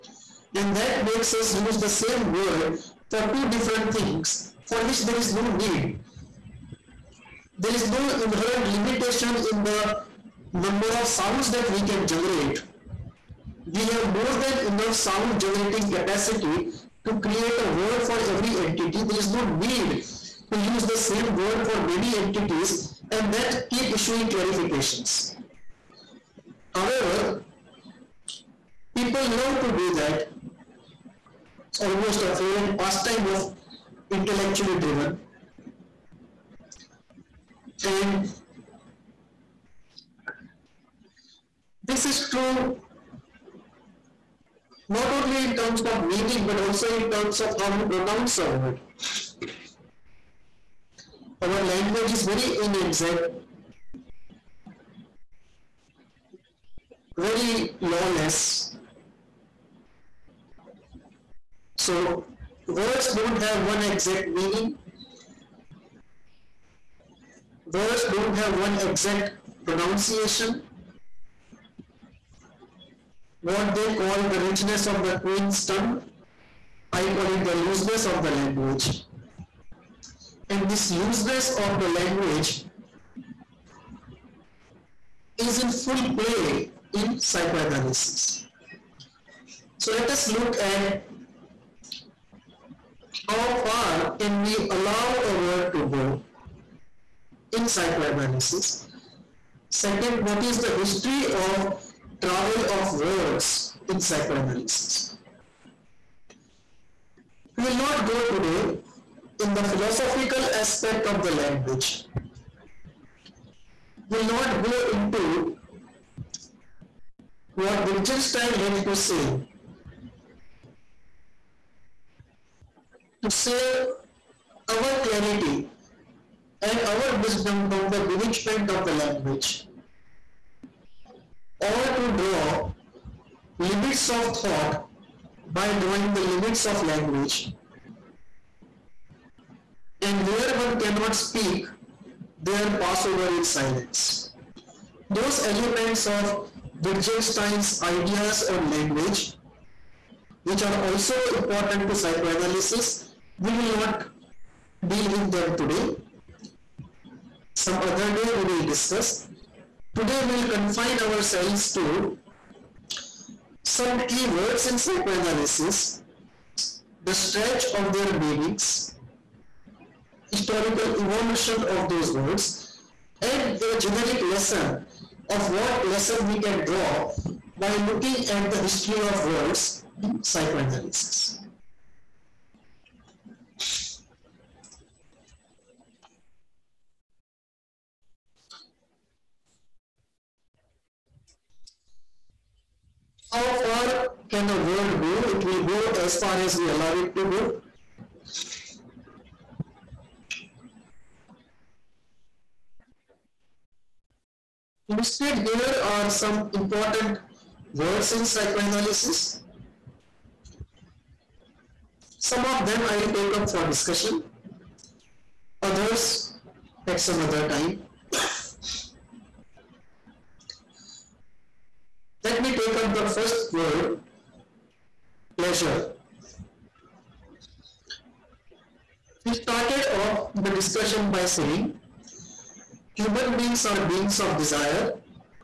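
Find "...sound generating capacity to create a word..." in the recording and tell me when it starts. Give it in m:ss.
0:14.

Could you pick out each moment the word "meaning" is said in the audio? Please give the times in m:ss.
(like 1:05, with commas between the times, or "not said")
0:46, 1:04, 2:48.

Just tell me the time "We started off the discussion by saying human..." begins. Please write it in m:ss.
3:49.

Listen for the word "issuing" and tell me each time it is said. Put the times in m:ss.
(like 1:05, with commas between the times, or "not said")
0:23.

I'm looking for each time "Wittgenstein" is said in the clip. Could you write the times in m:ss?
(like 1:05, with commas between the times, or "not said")
1:57, 2:26.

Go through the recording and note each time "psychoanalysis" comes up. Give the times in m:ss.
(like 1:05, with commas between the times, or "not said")
1:27, 1:37, 1:43, 2:31, 2:44, 3:00, 3:28.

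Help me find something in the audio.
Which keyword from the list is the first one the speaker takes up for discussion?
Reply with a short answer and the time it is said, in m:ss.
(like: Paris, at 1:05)
pleasure, at 3:45.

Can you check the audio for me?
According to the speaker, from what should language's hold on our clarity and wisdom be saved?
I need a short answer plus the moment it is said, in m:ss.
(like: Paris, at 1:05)
bewitchment, at 2:08.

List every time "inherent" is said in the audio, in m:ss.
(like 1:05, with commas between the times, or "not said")
0:08.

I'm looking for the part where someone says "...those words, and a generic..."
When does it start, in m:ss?
2:51.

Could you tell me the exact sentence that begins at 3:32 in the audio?
Some of them I'll take up for discussion, others at some other time.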